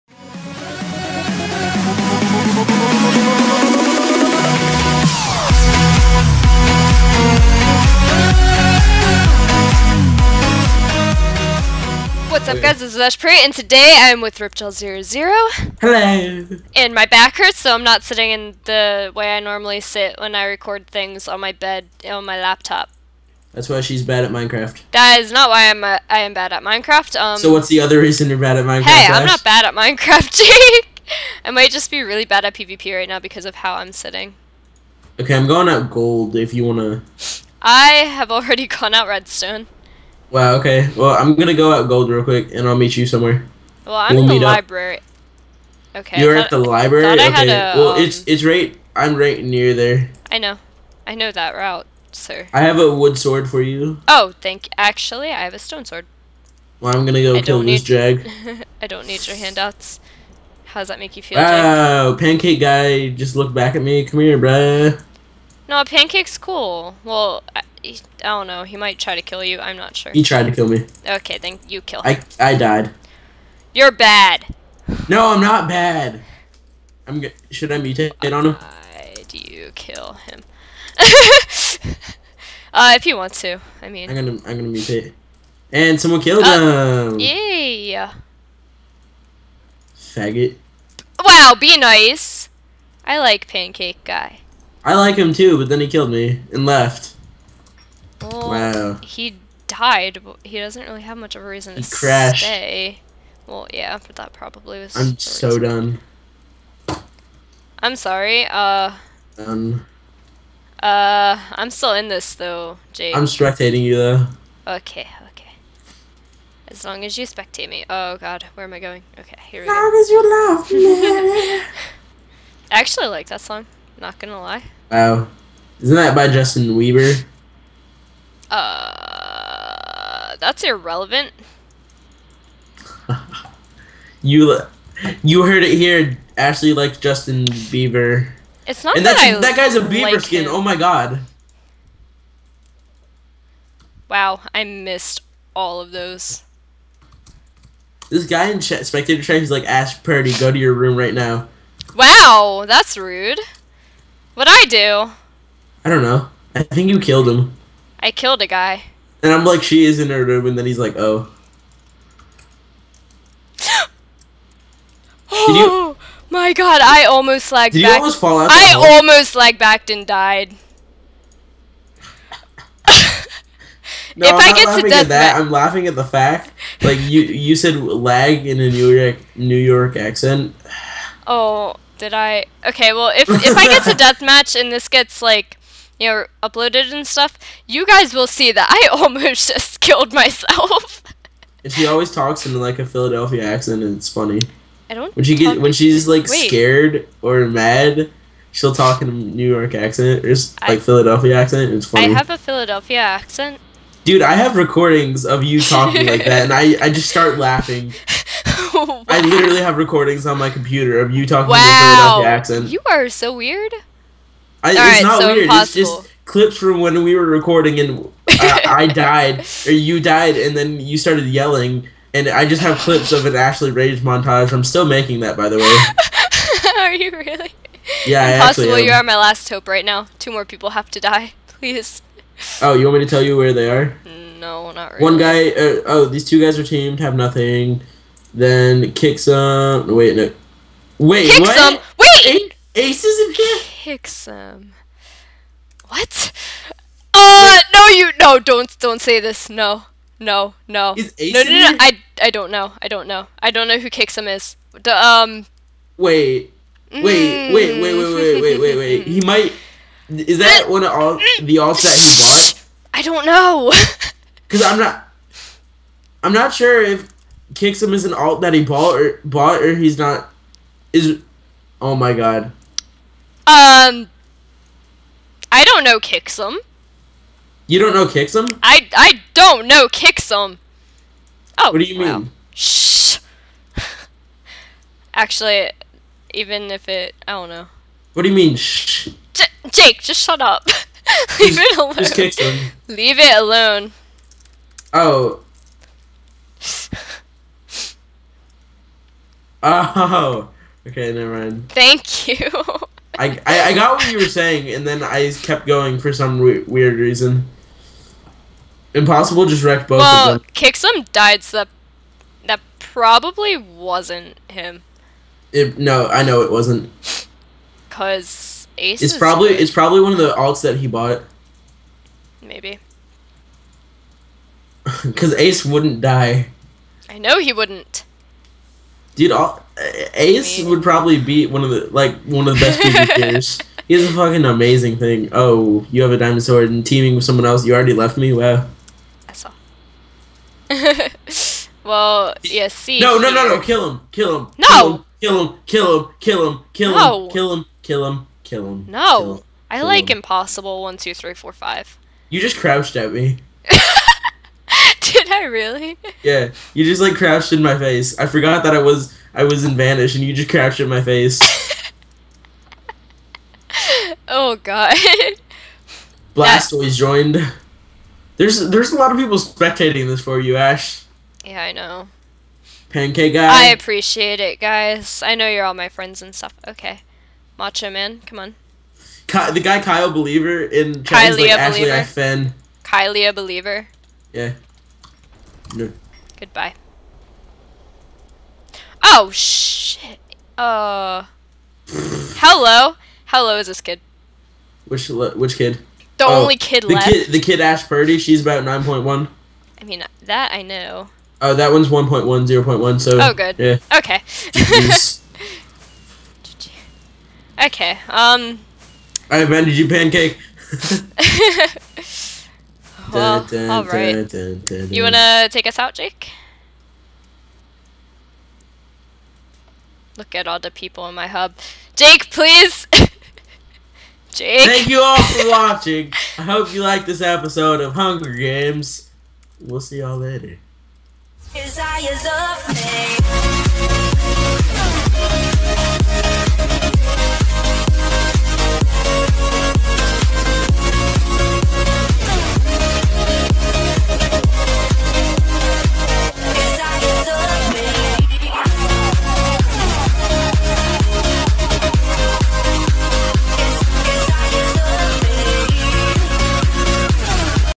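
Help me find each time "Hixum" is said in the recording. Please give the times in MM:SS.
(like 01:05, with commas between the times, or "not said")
04:03, 04:13.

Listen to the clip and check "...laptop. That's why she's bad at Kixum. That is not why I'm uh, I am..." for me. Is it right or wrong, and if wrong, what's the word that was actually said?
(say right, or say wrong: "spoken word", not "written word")
wrong: "Minecraft", not "Kixum".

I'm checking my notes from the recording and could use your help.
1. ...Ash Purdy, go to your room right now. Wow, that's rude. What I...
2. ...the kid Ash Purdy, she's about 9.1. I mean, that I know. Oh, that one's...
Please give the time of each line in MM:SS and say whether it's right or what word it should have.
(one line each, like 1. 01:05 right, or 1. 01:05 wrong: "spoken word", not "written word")
1. 02:29 right
2. 06:37 right.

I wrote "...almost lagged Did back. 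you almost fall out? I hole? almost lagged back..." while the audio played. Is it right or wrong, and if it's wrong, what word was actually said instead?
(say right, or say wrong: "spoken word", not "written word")
right.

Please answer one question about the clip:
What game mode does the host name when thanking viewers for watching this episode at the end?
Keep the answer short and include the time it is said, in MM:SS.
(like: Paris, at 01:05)
Hunger Games, at 07:07.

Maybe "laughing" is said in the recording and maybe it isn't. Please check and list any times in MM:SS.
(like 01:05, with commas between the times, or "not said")
02:55, 03:27.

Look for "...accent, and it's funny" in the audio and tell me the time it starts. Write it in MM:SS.
03:13.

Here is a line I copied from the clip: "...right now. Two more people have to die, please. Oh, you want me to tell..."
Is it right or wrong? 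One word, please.
right.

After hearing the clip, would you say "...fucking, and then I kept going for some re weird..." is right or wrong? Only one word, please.
wrong.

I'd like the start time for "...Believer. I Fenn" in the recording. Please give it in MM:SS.
06:21.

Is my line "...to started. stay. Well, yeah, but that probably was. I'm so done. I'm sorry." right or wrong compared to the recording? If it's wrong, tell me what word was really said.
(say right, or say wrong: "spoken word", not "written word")
wrong: "crashed", not "started".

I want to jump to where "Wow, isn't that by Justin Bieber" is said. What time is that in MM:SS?
02:04.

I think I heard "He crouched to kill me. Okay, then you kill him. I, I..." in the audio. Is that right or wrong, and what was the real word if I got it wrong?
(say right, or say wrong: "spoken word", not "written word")
wrong: "tried", not "crouched".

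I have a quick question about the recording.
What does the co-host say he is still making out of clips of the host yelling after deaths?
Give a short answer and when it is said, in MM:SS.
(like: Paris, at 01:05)
an Ashley Rage montage, at 03:43.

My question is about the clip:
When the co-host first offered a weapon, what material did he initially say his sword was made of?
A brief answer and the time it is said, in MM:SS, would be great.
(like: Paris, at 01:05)
wood, at 00:52.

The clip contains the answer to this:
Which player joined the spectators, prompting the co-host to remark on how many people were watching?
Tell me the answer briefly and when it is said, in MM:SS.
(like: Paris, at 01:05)
Blastoise, at 06:06.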